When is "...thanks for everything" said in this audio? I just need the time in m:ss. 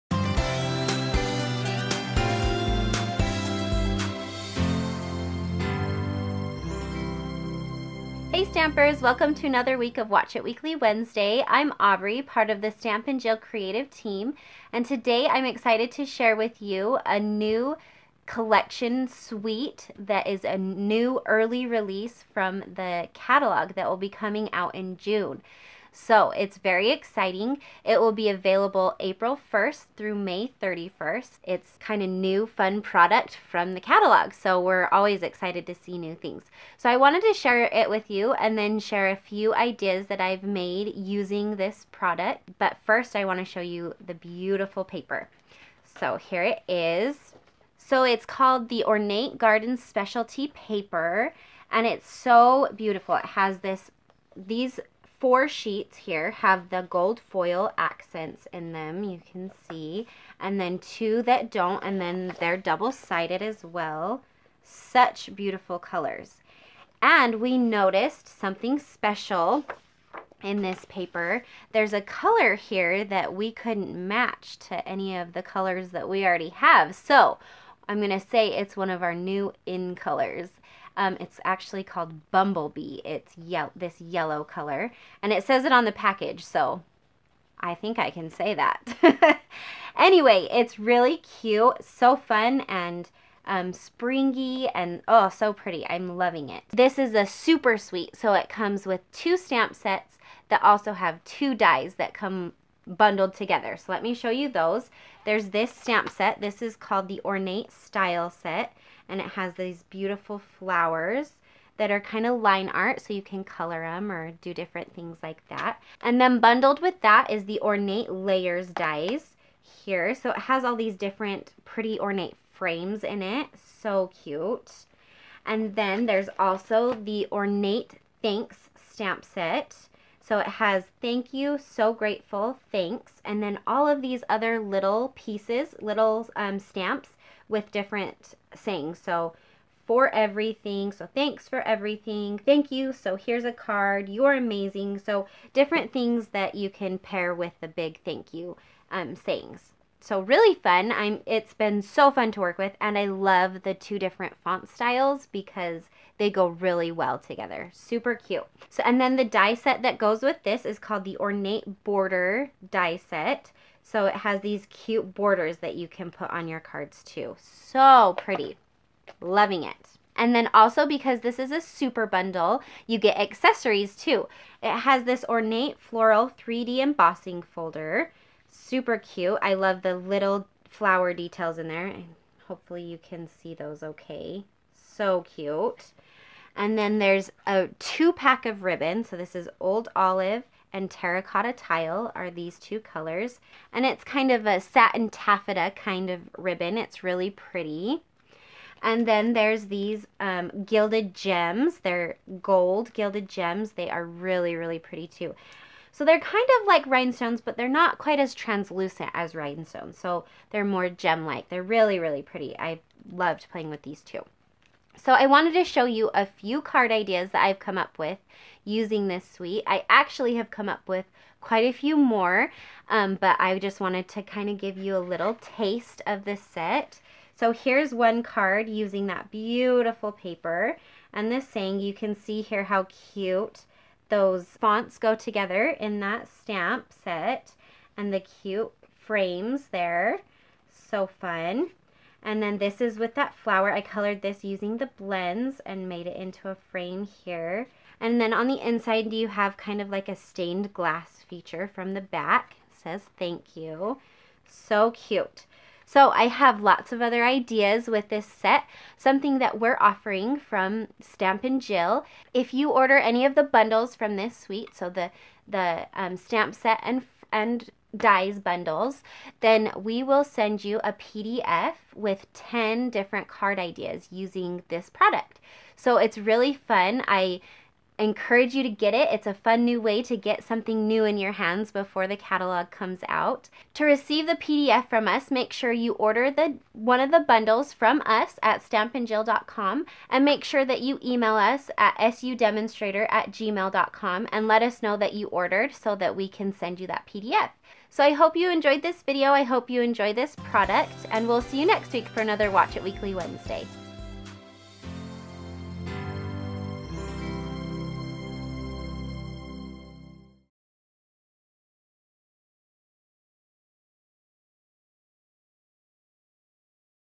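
2:21.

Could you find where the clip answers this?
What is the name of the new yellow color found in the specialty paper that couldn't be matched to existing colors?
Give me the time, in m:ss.
1:22.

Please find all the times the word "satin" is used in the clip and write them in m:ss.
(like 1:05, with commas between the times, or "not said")
3:14.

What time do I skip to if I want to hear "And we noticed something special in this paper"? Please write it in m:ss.
1:07.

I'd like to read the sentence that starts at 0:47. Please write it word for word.
So it's called the Ornate Garden Specialty Paper and it's so beautiful.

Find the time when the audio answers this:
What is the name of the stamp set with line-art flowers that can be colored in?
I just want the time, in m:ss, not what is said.
1:47.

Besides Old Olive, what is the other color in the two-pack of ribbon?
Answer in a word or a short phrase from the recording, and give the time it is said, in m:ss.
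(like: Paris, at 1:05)
Terracotta Tile, at 3:10.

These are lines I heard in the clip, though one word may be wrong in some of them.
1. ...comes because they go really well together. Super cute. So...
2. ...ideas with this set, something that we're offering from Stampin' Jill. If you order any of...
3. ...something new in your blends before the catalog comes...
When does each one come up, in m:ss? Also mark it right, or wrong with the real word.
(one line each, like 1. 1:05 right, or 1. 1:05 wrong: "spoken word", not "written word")
1. 2:34 wrong: "styles", not "comes"
2. 4:17 right
3. 4:40 wrong: "hands", not "blends".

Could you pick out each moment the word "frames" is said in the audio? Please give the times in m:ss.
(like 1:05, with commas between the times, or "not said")
2:02, 3:58, 4:06.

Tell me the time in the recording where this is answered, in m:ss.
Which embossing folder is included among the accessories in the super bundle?
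2:55.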